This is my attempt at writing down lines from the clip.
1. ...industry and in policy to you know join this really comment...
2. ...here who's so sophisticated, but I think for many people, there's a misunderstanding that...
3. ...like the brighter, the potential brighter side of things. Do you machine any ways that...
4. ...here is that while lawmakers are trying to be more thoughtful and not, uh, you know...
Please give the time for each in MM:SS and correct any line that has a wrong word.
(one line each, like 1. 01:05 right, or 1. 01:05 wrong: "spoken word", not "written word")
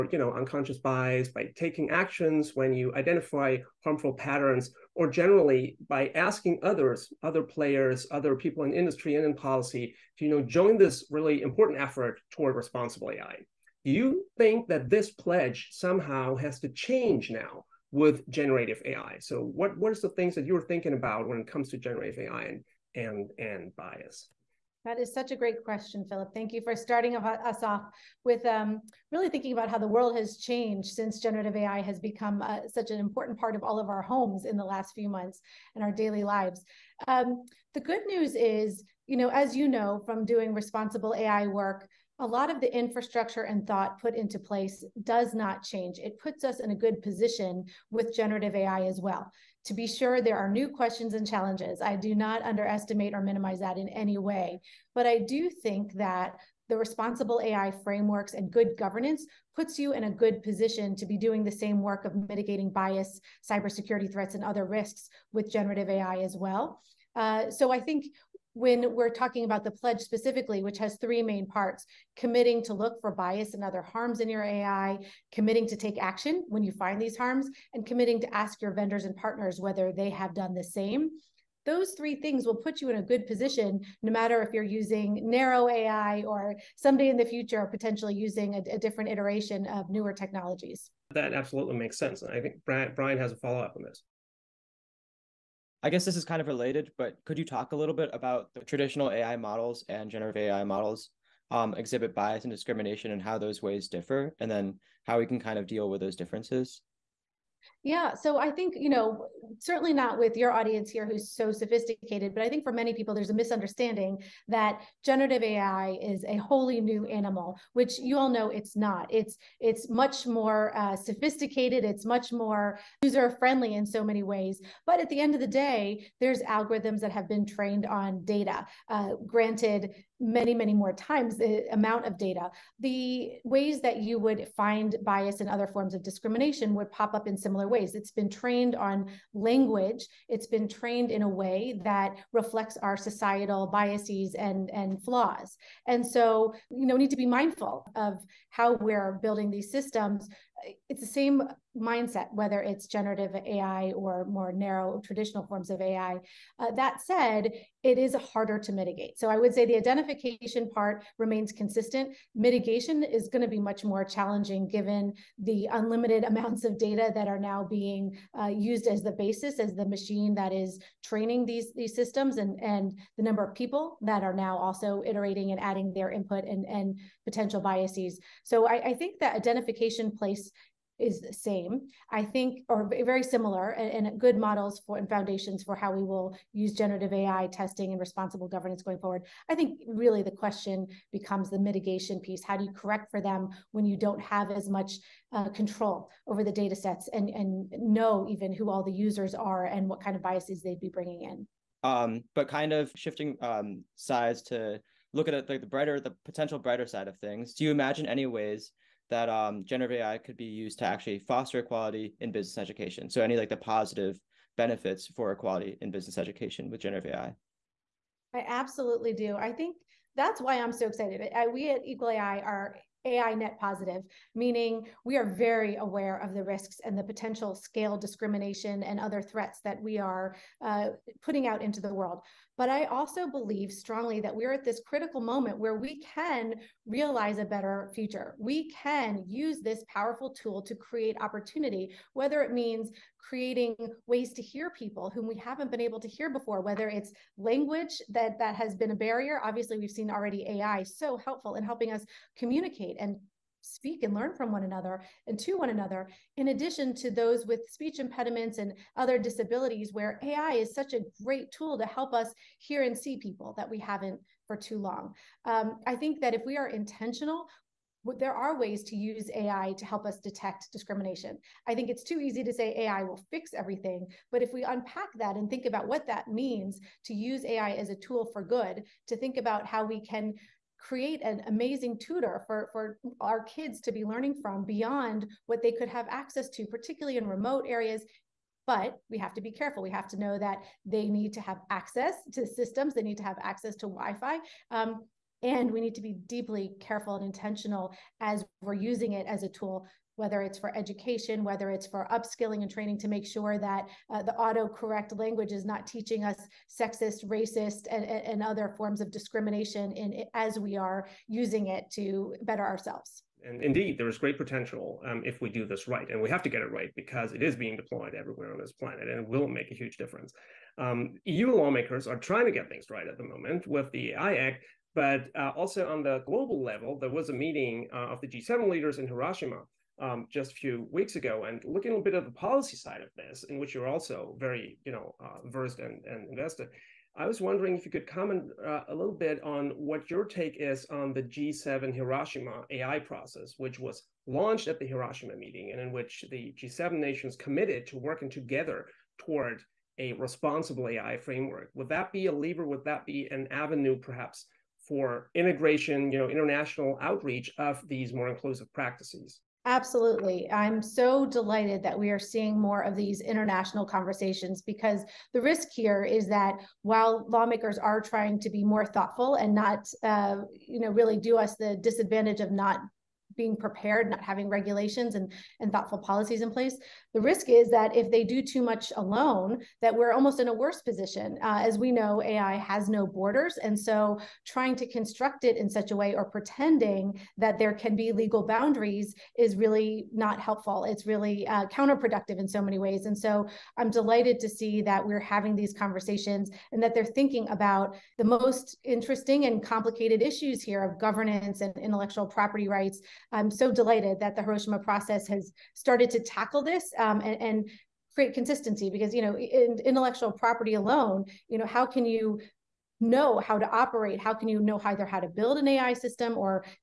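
1. 00:08 wrong: "important", not "comment"
2. 01:50 right
3. 03:25 wrong: "imagine", not "machine"
4. 06:05 right.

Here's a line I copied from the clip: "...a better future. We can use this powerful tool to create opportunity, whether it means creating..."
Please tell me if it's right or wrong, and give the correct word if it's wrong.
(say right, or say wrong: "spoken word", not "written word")
right.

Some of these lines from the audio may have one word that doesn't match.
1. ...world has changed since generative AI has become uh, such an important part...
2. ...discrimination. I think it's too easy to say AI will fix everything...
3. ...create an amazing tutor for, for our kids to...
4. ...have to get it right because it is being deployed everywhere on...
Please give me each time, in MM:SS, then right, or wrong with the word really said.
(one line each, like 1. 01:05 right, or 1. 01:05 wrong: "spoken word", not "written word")
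1. 00:29 right
2. 04:30 right
3. 04:40 right
4. 05:16 right.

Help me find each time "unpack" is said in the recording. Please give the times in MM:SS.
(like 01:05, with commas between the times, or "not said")
04:34.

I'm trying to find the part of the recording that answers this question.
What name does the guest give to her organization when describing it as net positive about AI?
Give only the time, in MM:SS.
03:41.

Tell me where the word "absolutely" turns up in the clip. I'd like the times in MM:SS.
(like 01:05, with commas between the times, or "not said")
01:31, 03:38, 05:59.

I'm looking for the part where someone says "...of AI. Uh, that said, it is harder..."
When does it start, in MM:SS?
02:35.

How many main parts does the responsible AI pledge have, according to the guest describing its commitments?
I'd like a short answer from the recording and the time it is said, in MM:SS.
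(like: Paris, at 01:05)
3, at 01:10.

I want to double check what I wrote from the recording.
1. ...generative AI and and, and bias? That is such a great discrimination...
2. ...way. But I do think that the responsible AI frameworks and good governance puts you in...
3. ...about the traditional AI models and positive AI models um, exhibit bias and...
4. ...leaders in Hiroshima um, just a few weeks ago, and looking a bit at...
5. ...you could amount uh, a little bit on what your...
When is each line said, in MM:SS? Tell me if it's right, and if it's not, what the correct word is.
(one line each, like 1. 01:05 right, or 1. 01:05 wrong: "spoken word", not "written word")
1. 00:21 wrong: "question", not "discrimination"
2. 00:54 right
3. 01:38 wrong: "generative", not "positive"
4. 05:28 right
5. 05:37 wrong: "comment", not "amount".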